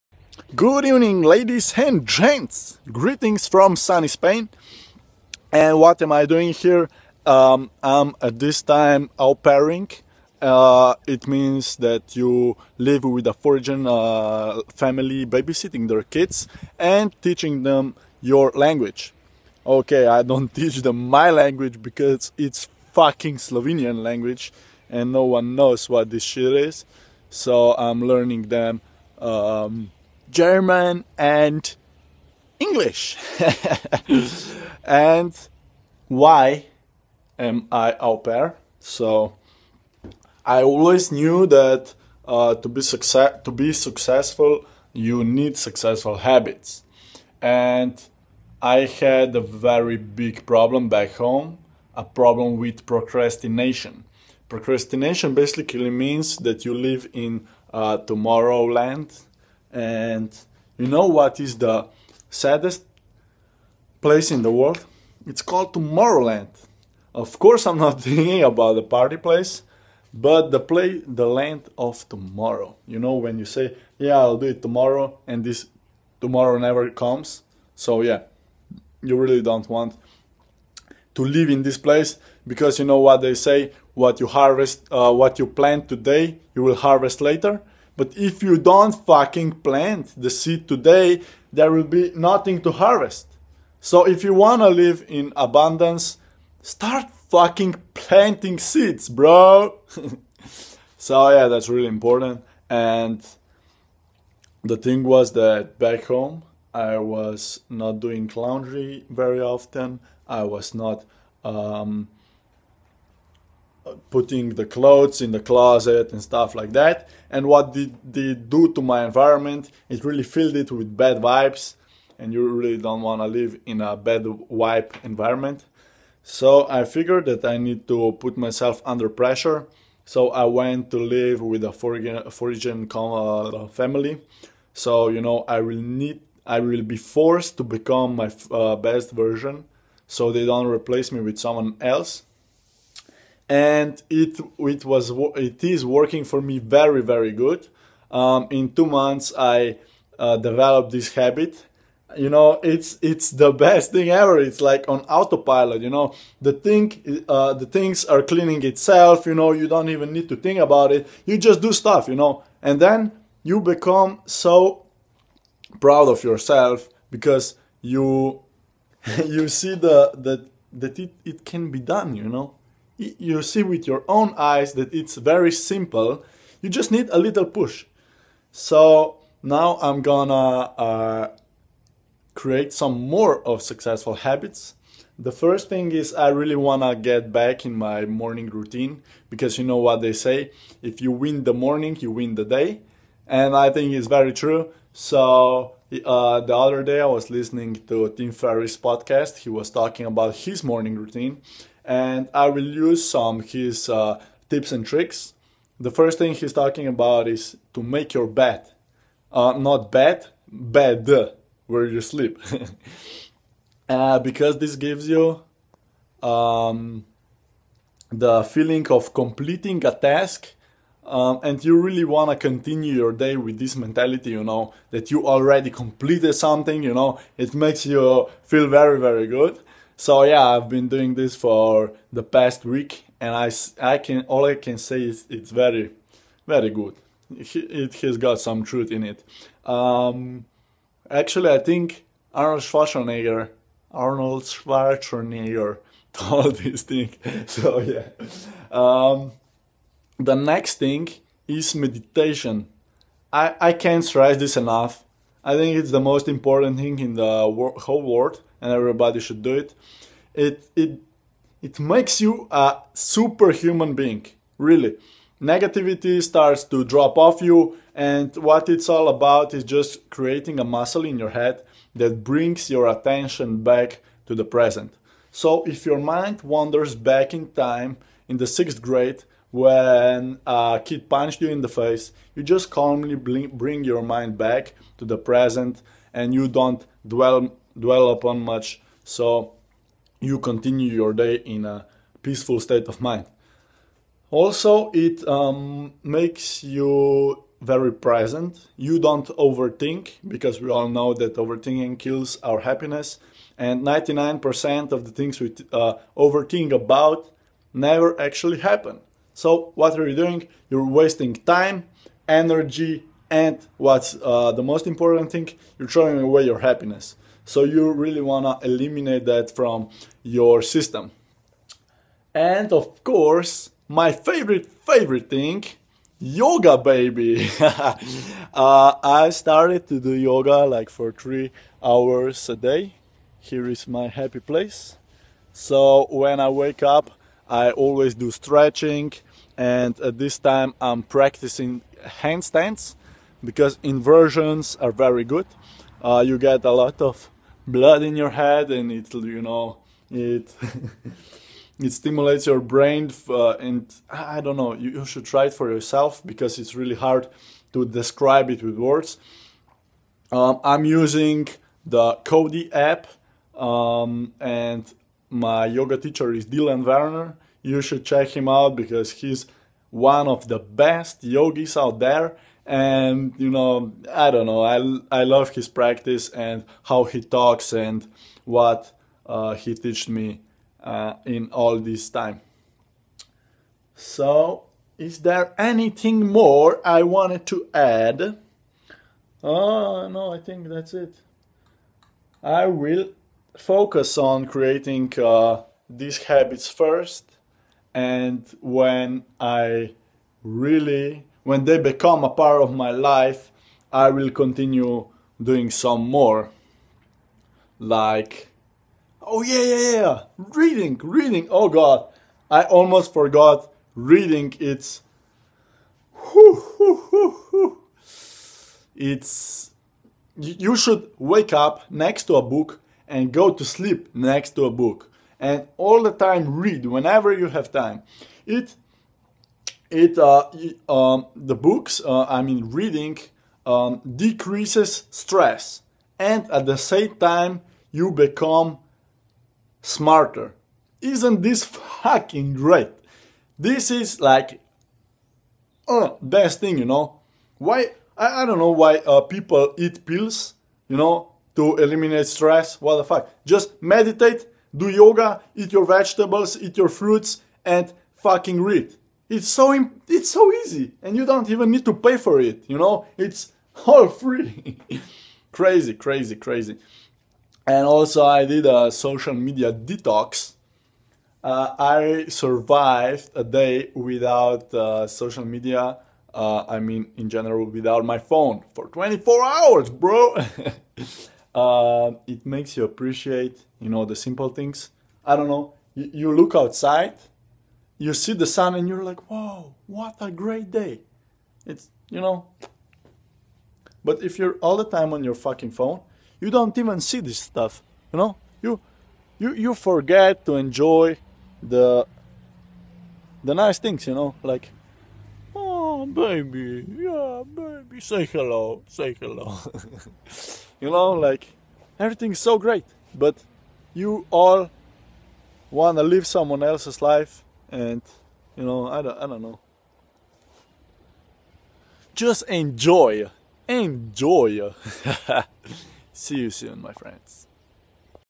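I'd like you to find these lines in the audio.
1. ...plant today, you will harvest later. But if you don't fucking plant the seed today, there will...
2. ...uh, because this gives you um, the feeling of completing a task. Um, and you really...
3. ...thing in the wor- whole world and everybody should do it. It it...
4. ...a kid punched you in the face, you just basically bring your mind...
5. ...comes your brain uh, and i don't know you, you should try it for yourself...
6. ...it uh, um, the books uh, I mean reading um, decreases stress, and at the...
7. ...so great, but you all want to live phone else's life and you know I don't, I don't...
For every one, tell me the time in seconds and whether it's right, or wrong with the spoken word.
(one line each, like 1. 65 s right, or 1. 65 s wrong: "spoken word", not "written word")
1. 85 s right
2. 213 s right
3. 256 s right
4. 280 s wrong: "calmly", not "basically"
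5. 351 s wrong: "stimulates", not "comes"
6. 429 s right
7. 512 s wrong: "someone", not "phone".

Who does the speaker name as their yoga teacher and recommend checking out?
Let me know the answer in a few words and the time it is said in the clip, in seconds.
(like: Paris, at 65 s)
Dylan Werner, at 366 s.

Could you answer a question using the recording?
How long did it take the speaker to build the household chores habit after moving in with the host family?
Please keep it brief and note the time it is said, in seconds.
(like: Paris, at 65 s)
2 months, at 148 s.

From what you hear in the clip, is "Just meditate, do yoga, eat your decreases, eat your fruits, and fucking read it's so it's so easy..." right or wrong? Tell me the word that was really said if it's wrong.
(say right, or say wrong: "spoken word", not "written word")
wrong: "vegetables", not "decreases".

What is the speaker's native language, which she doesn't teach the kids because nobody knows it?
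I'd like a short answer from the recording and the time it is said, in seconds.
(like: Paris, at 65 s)
Slovenian, at 23 s.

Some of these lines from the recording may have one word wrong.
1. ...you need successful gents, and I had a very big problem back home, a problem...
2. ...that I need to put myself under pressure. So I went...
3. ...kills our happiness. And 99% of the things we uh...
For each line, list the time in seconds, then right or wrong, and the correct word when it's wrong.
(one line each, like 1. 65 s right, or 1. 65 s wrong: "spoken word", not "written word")
1. 44 s wrong: "habits", not "gents"
2. 127 s right
3. 301 s right.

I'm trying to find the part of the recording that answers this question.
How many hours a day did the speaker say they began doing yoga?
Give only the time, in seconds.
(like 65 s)
331 s.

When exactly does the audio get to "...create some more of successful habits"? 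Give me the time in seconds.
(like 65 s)
182 s.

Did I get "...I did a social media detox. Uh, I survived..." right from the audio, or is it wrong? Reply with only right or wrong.
right.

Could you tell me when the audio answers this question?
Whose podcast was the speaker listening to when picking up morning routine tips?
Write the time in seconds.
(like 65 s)
198 s.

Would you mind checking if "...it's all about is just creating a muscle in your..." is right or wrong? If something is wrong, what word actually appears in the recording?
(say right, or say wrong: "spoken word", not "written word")
right.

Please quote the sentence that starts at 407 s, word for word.
Like, oh yeah, yeah, yeah, reading, reading.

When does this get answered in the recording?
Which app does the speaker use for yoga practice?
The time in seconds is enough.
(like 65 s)
362 s.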